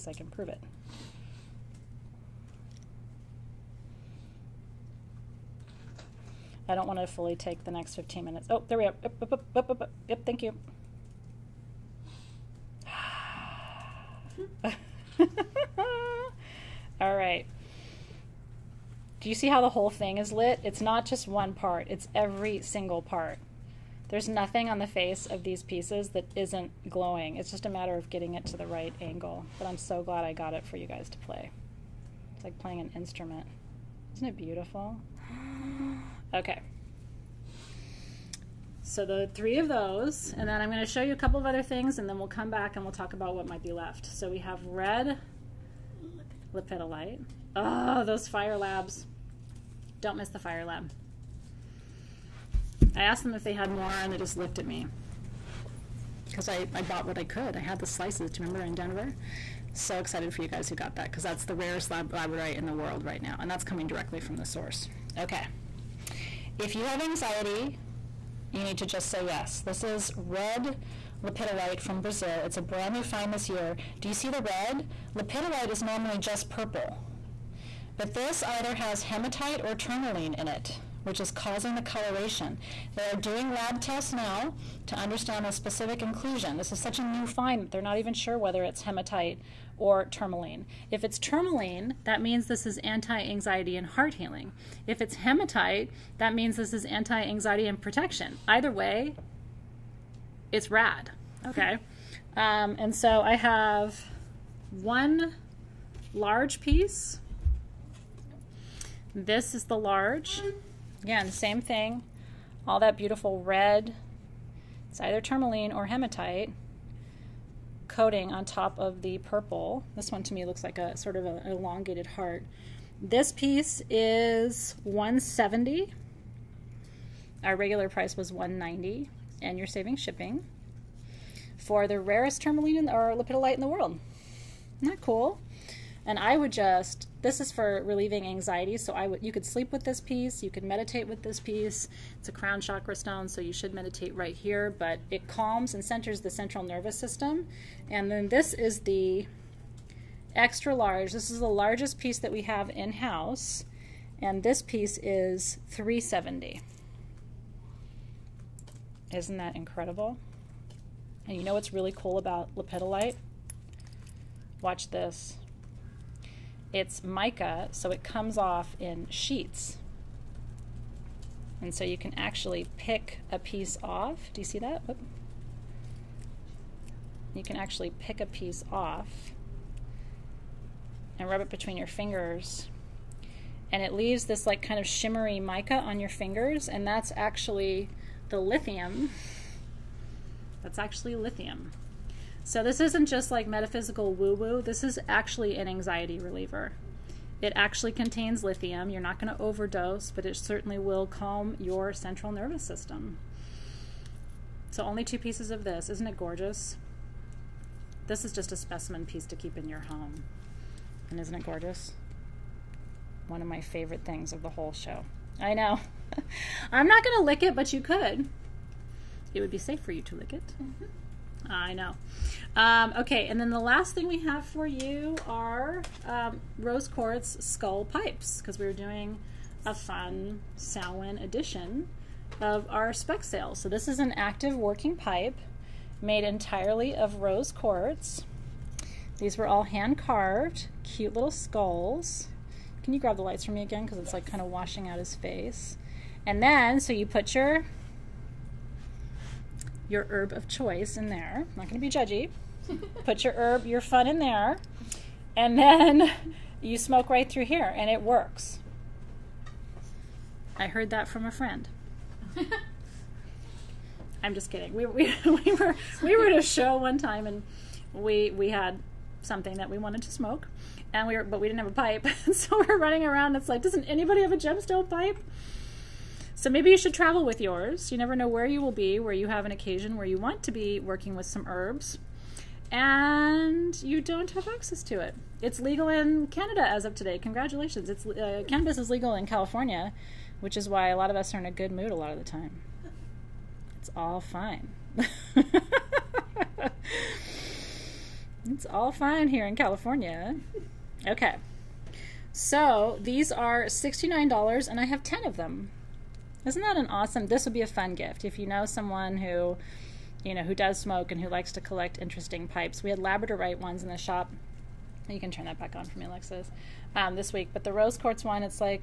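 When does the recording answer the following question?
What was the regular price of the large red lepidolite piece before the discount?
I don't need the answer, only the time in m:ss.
2:08.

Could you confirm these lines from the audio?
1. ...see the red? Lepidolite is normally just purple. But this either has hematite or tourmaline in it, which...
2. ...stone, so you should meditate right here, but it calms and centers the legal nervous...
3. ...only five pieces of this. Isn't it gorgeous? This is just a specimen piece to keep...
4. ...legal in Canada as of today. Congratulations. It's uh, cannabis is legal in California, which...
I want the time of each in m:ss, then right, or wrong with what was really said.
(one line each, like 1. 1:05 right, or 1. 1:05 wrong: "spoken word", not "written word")
1. 1:14 right
2. 2:22 wrong: "central", not "legal"
3. 3:24 wrong: "two", not "five"
4. 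4:45 right.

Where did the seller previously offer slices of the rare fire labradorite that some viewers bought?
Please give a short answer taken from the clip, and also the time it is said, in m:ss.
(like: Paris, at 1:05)
Denver, at 0:58.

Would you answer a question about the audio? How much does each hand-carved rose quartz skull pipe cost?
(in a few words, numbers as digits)
$69.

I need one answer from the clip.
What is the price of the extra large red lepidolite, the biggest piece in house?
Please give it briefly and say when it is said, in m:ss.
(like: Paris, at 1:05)
370, at 2:35.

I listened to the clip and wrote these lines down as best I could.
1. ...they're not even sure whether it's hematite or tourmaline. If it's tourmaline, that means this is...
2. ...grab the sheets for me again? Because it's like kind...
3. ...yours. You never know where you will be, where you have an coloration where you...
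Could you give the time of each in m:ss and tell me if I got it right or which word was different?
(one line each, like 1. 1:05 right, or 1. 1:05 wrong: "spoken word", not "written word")
1. 1:27 right
2. 4:02 wrong: "lights", not "sheets"
3. 4:37 wrong: "occasion", not "coloration".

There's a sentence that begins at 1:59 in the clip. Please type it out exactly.
This one to me looks like a sort of an elongated heart.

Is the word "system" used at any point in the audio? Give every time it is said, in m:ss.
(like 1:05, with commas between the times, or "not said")
2:26, 3:22.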